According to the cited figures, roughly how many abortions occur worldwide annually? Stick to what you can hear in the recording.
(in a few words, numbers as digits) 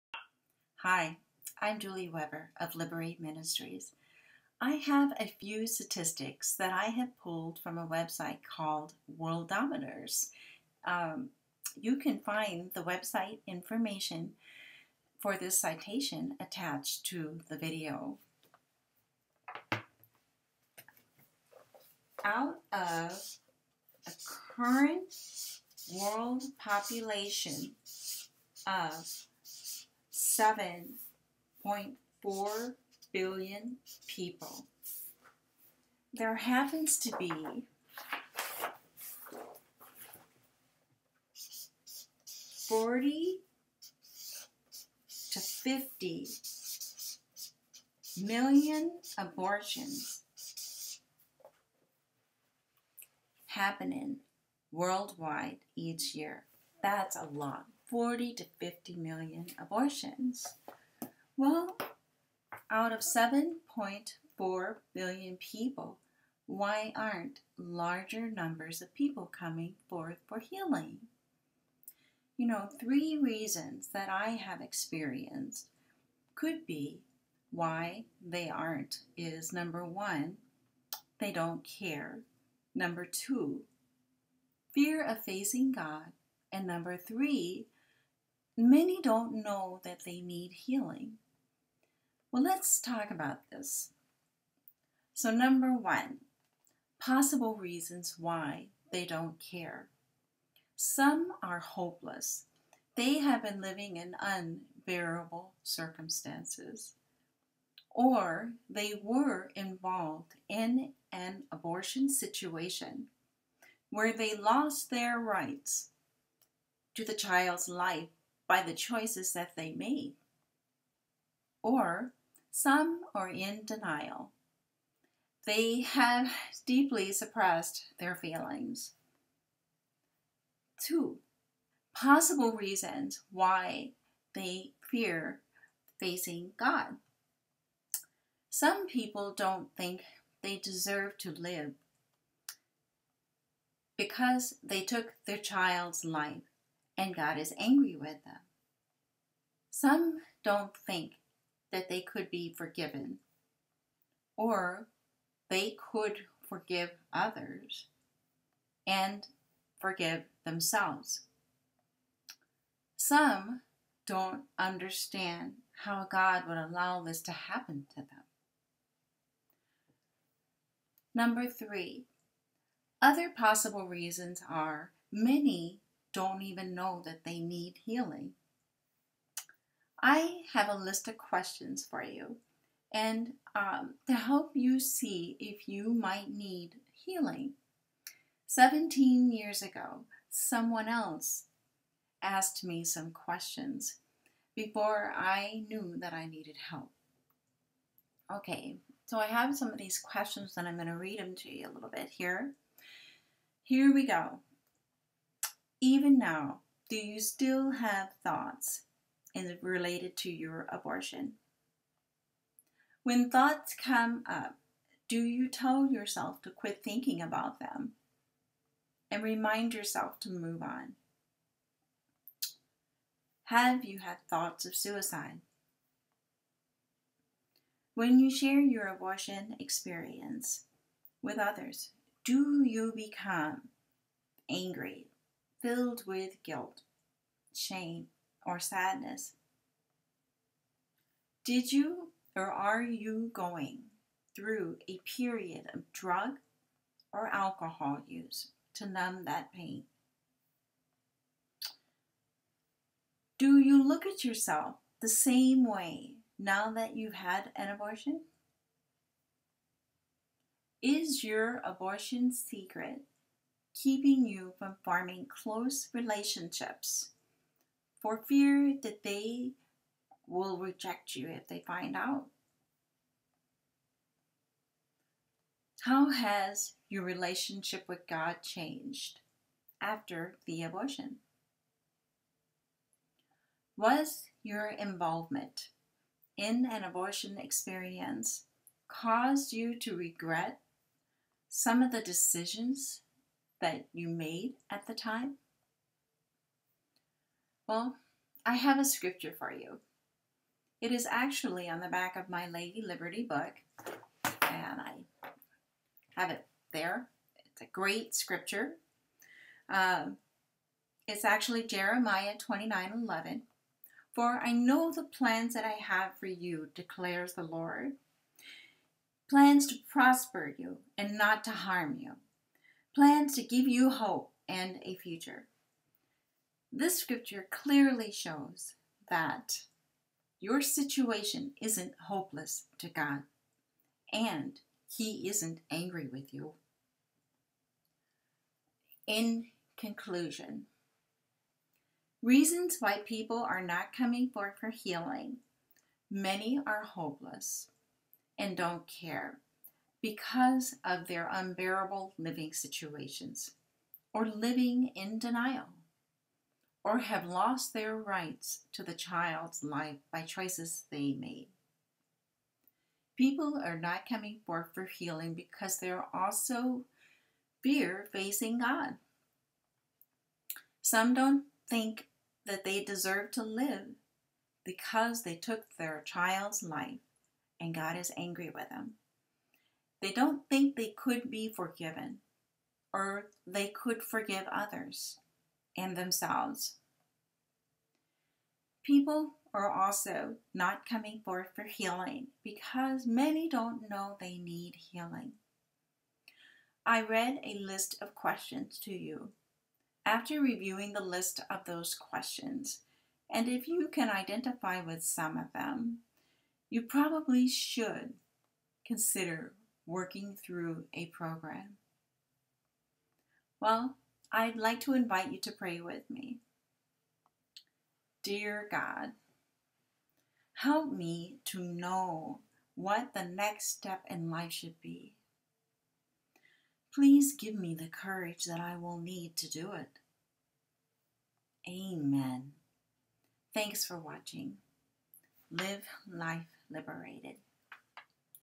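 40 to 50 million.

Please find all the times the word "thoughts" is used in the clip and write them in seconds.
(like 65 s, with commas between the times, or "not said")
208 s, 213 s, 224 s.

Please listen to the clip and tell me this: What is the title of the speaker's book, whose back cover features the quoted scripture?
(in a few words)
Lady Liberty.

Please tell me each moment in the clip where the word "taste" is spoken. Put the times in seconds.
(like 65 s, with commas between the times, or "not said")
not said.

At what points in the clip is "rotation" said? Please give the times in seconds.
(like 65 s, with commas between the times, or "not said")
not said.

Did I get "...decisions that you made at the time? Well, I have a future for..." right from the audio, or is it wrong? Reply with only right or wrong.
wrong.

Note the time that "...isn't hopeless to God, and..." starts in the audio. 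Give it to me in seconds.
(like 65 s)
331 s.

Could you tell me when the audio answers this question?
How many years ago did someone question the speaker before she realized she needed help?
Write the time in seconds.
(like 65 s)
188 s.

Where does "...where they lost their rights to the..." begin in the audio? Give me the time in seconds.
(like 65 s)
113 s.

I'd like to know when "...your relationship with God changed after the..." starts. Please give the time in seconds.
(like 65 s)
276 s.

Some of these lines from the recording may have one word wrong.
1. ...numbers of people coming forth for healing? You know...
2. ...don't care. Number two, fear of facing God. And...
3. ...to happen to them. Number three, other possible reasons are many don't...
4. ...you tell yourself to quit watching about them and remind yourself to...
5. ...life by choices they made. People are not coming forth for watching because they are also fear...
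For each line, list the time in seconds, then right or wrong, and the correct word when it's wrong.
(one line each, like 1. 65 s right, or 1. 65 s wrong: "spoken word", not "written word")
1. 68 s right
2. 81 s right
3. 167 s right
4. 215 s wrong: "thinking", not "watching"
5. 359 s wrong: "healing", not "watching".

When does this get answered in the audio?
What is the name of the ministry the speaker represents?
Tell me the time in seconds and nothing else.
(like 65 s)
2 s.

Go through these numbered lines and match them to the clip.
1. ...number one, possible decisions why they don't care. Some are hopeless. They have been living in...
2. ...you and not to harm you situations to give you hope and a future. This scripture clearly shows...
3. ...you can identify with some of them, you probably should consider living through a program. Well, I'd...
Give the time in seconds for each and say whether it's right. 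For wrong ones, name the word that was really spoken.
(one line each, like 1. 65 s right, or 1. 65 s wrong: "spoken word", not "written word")
1. 95 s wrong: "reasons", not "decisions"
2. 320 s wrong: "plans", not "situations"
3. 403 s wrong: "working", not "living".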